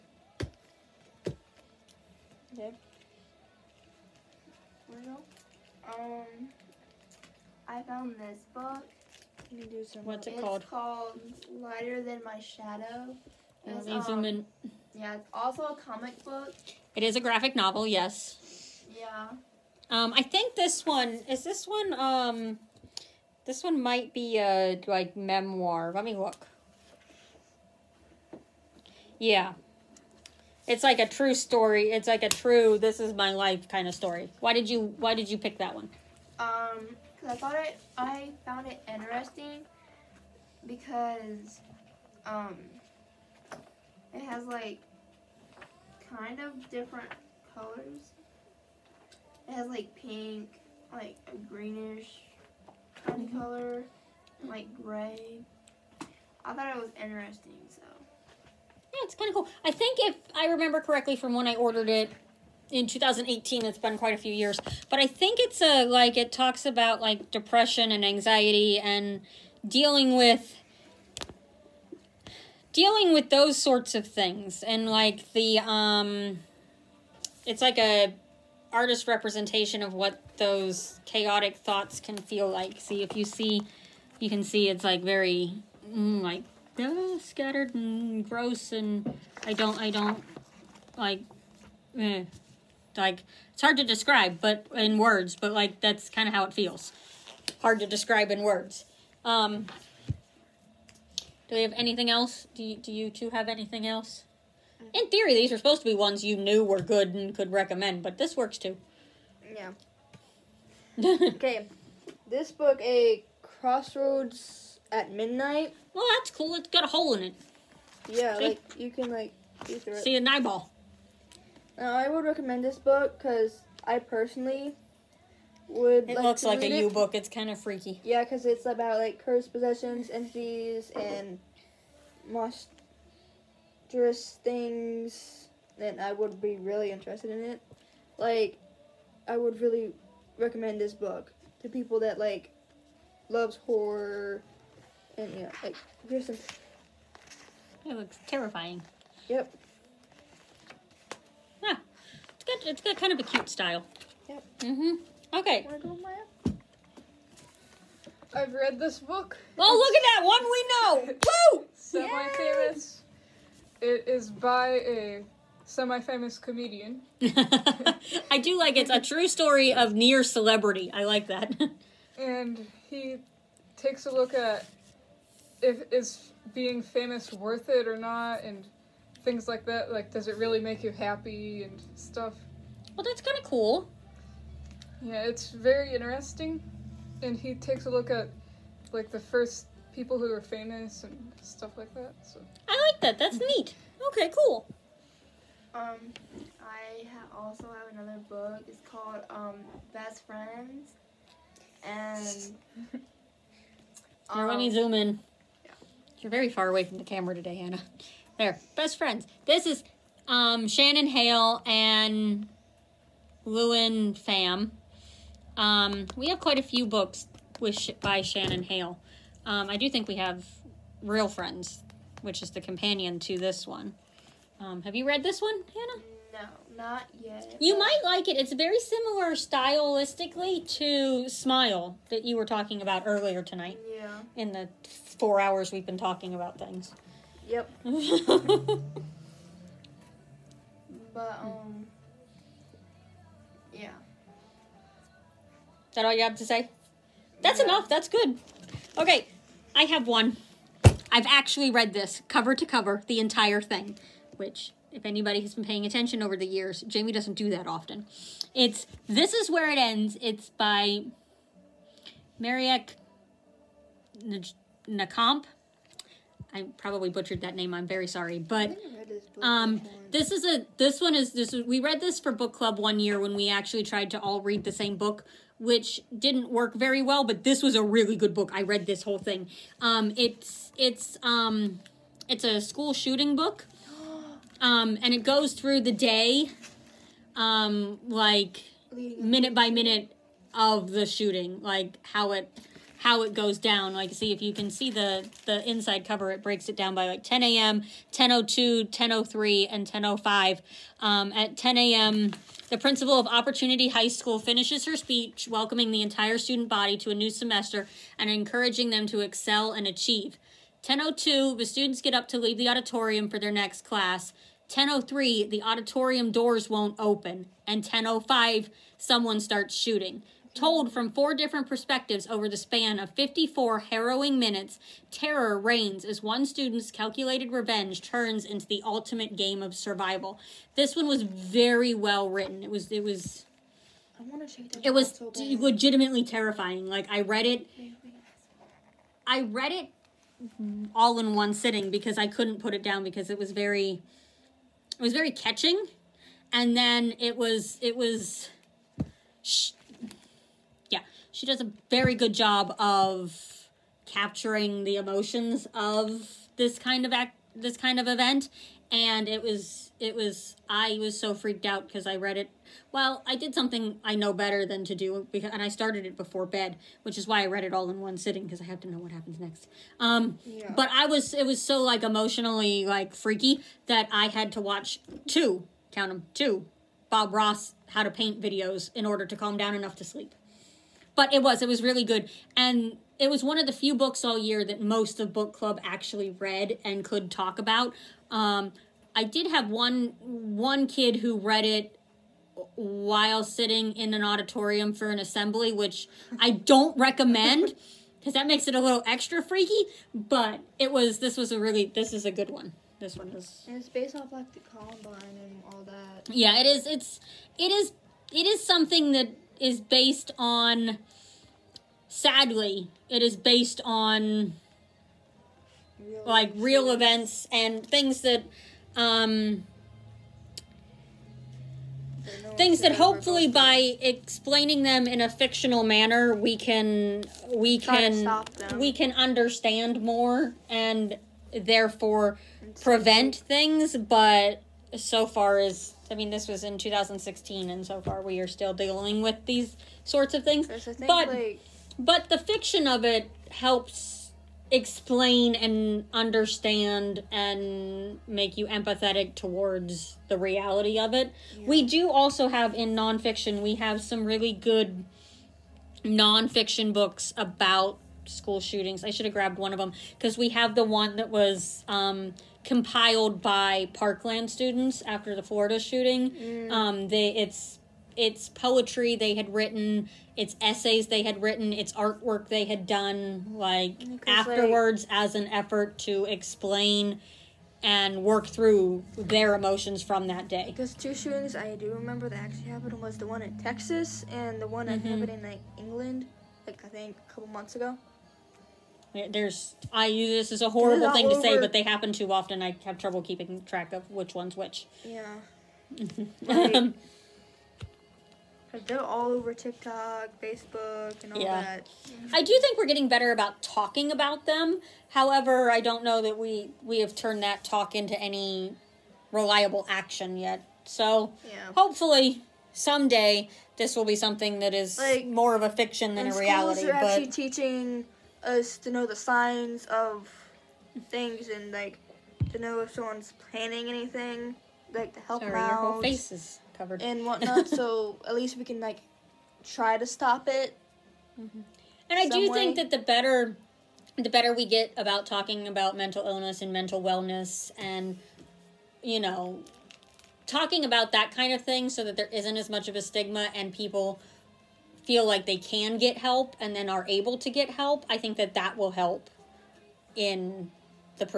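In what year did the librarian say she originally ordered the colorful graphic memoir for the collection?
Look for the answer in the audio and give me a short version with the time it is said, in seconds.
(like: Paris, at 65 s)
2018, at 62 s.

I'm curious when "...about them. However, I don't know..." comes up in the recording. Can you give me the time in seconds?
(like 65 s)
504 s.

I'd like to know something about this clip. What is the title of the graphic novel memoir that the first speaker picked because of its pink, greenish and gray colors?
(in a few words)
Lighter Than My Shadow.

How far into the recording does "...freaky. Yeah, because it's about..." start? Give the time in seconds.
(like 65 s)
127 s.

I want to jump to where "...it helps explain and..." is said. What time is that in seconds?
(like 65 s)
443 s.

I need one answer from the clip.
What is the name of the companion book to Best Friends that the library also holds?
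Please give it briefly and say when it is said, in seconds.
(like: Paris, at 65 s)
Real Friends, at 221 s.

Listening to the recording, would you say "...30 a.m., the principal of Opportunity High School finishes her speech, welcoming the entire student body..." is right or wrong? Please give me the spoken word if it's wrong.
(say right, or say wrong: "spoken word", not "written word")
wrong: "10", not "30".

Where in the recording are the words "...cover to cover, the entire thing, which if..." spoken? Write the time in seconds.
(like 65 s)
252 s.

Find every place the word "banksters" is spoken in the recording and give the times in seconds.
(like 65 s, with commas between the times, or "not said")
not said.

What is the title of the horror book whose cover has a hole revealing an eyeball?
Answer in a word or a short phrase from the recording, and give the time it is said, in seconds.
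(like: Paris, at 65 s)
A Crossroads at Midnight, at 112 s.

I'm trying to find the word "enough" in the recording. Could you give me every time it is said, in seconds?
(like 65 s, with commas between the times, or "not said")
247 s, 379 s.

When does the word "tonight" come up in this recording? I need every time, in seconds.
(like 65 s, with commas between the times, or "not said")
233 s.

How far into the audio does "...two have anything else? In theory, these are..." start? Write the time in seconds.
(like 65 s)
103 s.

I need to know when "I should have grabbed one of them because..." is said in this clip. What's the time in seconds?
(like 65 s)
459 s.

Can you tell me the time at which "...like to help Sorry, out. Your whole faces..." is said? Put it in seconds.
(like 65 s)
524 s.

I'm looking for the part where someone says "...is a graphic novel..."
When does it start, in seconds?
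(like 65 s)
17 s.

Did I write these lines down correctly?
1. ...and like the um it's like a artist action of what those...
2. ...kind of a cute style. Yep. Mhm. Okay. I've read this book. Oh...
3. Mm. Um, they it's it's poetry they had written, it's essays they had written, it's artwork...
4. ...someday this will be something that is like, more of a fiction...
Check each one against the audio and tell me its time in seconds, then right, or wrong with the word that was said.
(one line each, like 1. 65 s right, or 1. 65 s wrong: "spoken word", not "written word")
1. 74 s wrong: "representation", not "action"
2. 152 s right
3. 466 s right
4. 512 s right.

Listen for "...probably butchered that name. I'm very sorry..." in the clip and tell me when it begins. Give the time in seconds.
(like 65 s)
266 s.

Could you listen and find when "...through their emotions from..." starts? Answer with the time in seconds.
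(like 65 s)
478 s.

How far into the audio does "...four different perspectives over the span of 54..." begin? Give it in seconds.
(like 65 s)
321 s.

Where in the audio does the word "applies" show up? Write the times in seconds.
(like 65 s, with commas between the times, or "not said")
not said.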